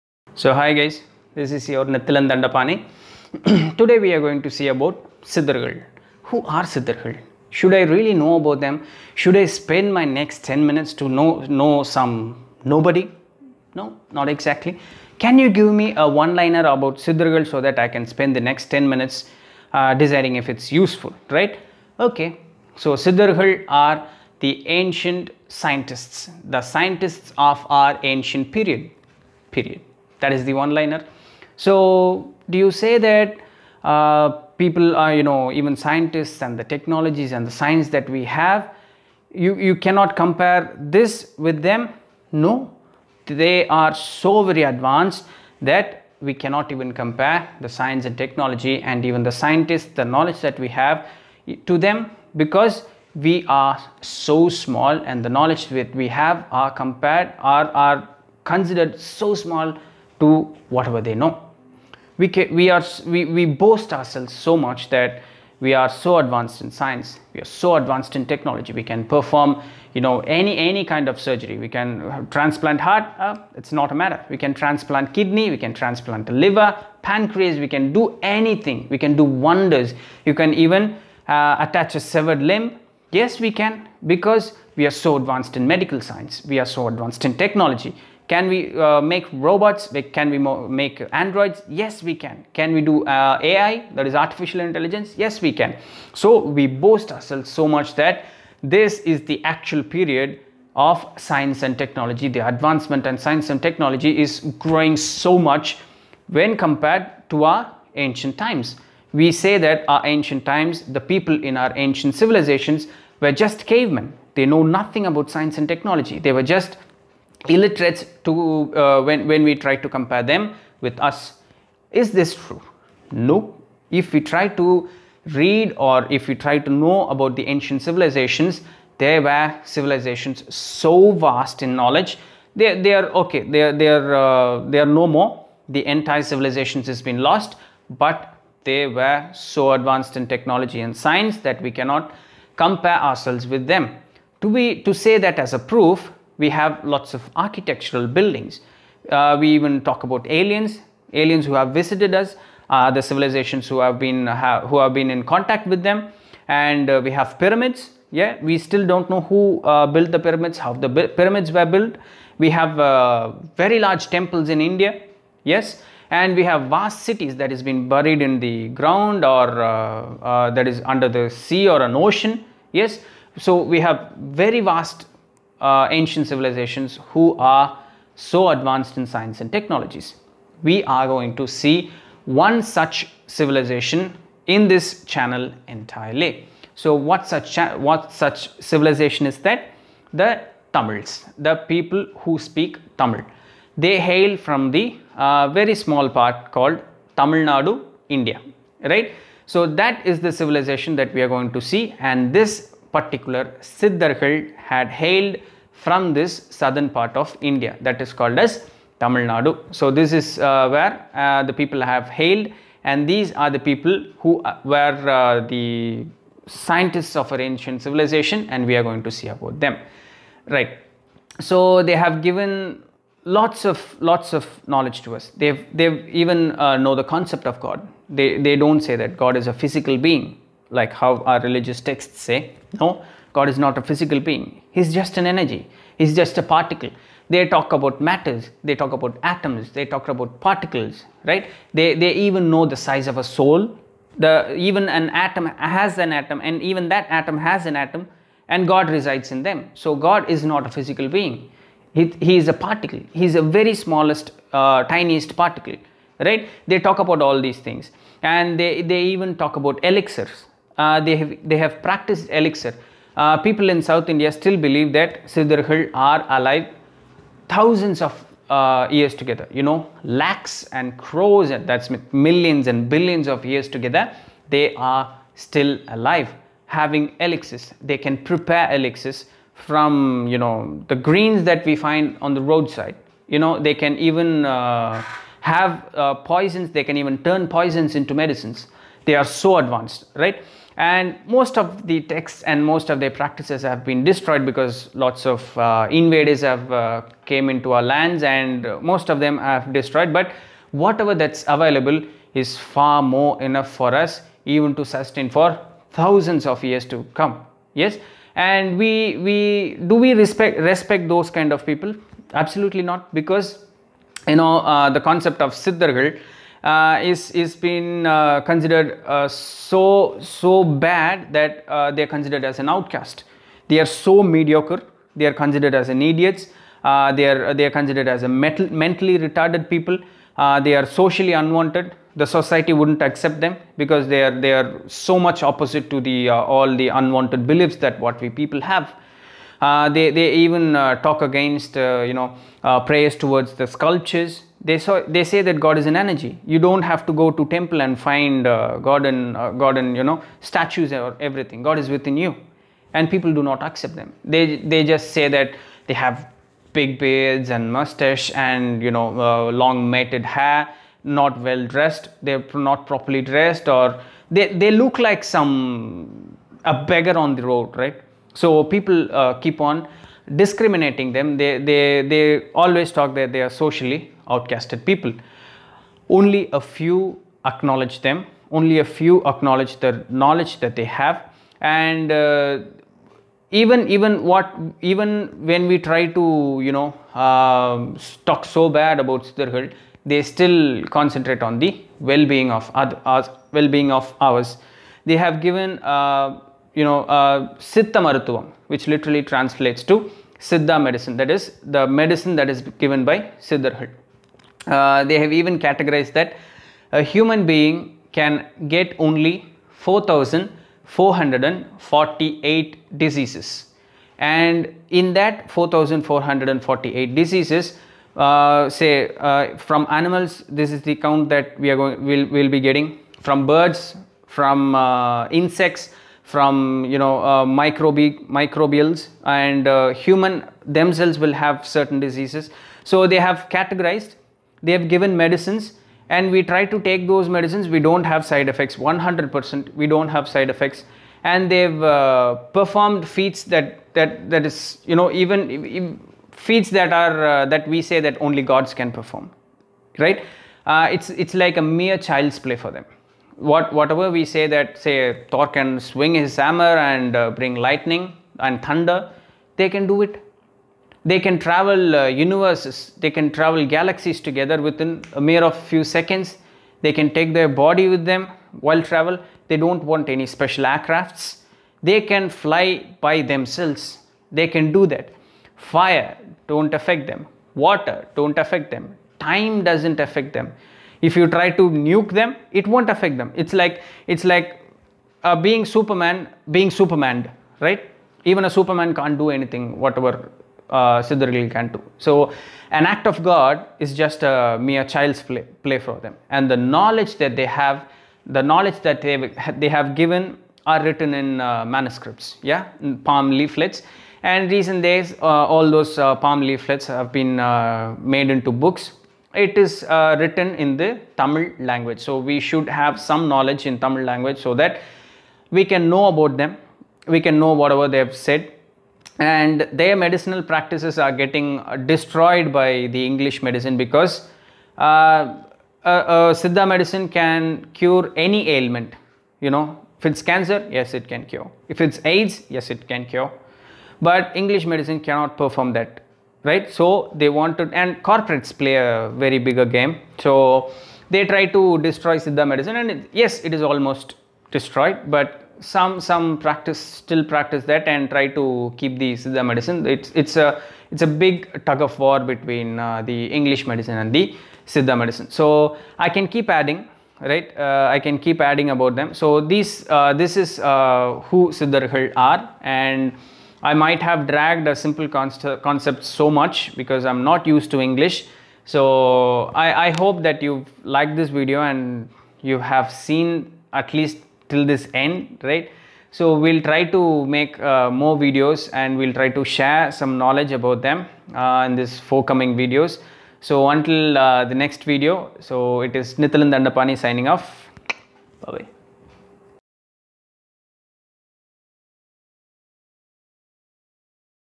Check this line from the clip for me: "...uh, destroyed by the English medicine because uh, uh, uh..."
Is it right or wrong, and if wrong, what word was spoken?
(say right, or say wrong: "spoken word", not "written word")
right.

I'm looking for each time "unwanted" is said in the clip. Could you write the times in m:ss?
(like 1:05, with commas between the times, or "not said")
5:31, 5:36.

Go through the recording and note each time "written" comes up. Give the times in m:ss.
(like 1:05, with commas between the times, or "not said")
8:20, 8:30.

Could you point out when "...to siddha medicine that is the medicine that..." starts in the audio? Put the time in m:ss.
6:39.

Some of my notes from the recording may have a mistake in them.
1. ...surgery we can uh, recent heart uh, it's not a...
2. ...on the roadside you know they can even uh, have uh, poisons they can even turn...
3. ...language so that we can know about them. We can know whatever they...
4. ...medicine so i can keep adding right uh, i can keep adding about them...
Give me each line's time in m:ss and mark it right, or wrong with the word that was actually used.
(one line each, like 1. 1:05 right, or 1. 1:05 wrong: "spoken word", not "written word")
1. 1:11 wrong: "transplant", not "recent"
2. 4:42 right
3. 8:34 right
4. 9:14 right.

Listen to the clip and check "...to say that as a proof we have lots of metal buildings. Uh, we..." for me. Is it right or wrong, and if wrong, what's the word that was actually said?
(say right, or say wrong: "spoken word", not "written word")
wrong: "architectural", not "metal".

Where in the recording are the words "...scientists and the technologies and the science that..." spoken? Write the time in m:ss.
0:35.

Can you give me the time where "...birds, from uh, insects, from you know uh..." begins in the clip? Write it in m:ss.
7:03.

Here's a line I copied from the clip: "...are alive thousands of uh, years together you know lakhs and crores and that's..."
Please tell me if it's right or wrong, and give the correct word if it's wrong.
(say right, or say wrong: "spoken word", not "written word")
right.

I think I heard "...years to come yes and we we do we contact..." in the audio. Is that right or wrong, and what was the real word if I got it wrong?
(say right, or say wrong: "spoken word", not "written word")
wrong: "respect", not "contact".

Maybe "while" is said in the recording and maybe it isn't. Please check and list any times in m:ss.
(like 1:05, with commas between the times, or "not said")
7:48.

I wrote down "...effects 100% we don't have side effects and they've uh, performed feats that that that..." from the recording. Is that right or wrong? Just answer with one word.
right.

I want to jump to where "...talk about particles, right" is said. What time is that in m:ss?
3:59.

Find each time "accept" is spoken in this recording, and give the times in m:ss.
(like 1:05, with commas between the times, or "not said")
5:33, 5:53.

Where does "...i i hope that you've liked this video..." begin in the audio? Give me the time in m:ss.
9:29.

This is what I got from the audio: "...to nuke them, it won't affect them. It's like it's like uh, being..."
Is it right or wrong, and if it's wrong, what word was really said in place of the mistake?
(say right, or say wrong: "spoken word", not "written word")
right.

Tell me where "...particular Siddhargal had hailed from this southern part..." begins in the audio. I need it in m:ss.
3:22.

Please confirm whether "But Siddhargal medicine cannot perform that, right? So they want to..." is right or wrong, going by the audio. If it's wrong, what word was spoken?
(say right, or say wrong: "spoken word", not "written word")
wrong: "English", not "Siddhargal".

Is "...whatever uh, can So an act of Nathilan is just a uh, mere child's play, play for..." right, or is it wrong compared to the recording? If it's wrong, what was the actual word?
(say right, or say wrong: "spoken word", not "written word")
wrong: "God", not "Nathilan".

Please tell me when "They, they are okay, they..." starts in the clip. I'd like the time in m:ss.
2:12.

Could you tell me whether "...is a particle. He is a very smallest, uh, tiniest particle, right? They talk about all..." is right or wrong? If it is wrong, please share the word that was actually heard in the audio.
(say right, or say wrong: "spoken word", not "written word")
right.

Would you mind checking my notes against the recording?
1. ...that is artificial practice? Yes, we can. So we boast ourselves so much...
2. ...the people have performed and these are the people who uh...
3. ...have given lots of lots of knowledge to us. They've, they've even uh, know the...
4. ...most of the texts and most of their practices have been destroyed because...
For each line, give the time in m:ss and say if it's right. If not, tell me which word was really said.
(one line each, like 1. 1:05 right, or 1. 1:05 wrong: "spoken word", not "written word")
1. 1:33 wrong: "intelligence", not "practice"
2. 3:31 wrong: "hailed", not "performed"
3. 3:41 right
4. 4:51 right.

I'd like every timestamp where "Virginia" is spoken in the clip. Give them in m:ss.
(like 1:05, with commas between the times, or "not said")
not said.